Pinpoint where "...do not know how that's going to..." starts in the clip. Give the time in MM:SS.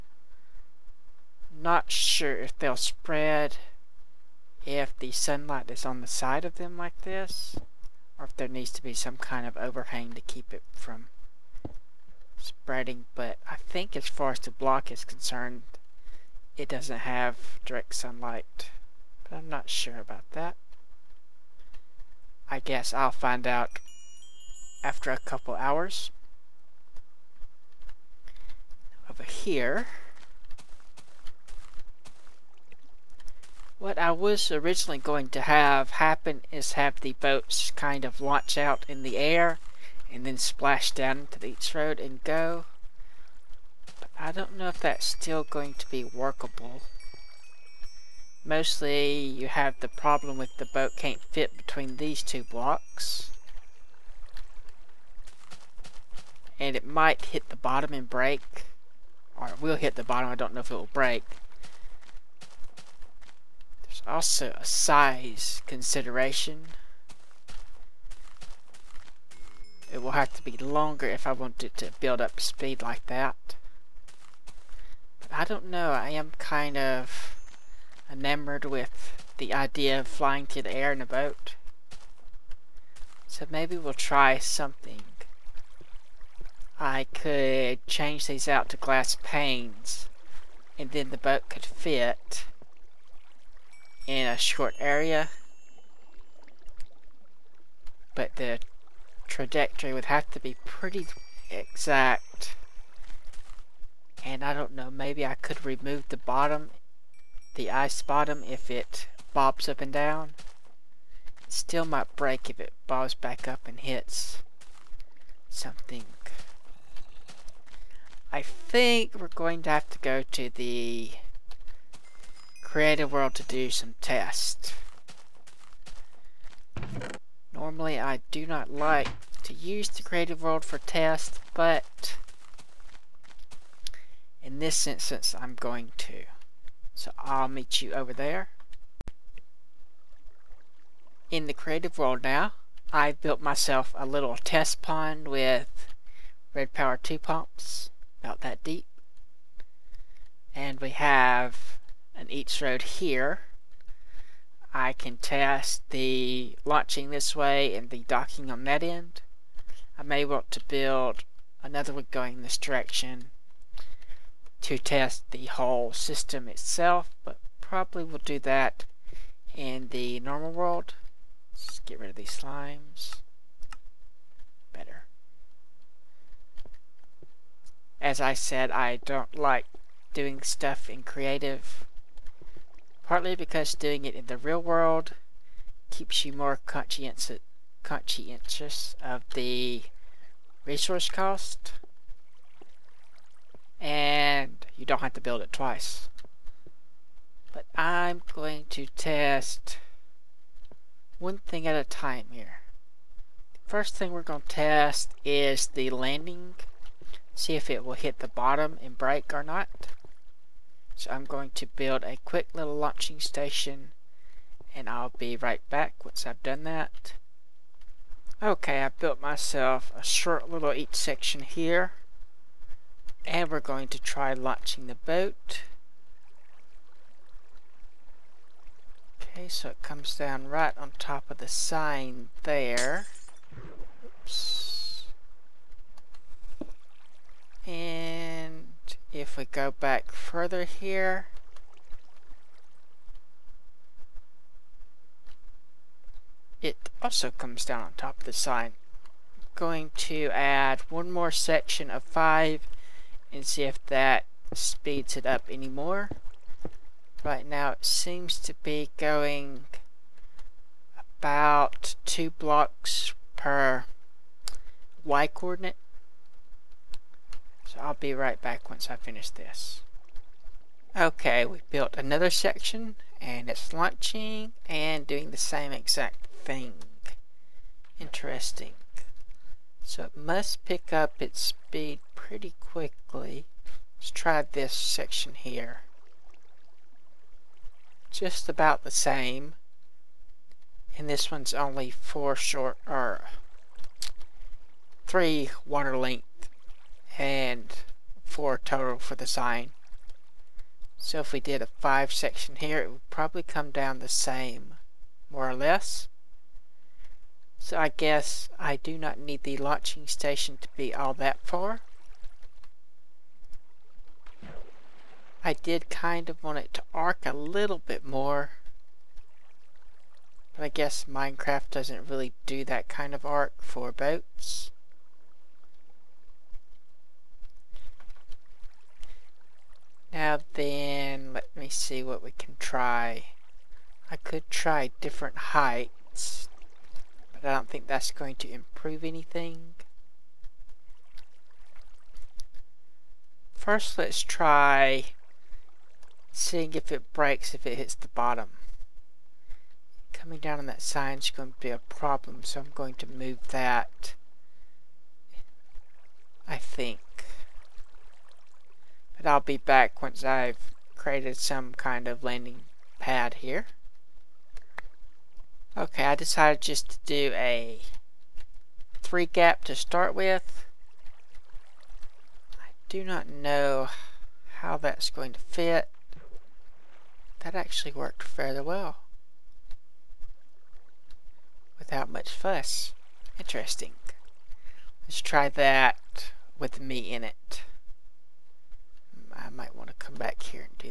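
06:12.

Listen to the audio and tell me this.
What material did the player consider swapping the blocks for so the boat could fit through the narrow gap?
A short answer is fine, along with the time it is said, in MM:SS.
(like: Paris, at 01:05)
glass panes, at 01:28.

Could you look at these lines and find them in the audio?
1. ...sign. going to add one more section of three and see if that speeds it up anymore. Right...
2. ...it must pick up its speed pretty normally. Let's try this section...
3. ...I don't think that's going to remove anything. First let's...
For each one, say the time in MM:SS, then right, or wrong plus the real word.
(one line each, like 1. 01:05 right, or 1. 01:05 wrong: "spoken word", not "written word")
1. 04:08 wrong: "five", not "three"
2. 04:40 wrong: "quickly", not "normally"
3. 05:37 wrong: "improve", not "remove".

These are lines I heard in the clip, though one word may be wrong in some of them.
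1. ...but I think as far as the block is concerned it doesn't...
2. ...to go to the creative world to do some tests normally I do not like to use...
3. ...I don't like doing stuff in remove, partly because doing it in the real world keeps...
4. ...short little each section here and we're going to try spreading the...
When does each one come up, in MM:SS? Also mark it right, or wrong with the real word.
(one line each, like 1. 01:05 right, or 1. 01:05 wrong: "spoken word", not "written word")
1. 00:13 right
2. 01:59 right
3. 02:58 wrong: "creative", not "remove"
4. 03:40 wrong: "latching", not "spreading".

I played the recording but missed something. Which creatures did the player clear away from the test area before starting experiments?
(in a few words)
slimes.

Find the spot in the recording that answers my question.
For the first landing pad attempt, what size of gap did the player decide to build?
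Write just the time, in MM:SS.
06:09.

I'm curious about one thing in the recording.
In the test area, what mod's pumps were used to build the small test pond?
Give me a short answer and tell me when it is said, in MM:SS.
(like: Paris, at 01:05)
Red Power 2, at 02:26.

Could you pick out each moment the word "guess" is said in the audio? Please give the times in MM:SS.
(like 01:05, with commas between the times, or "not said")
00:22, 05:07, 05:20.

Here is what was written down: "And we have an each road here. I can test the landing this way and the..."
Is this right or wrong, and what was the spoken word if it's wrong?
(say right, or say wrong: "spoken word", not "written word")
wrong: "launching", not "landing".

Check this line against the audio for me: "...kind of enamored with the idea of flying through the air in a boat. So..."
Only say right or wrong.
right.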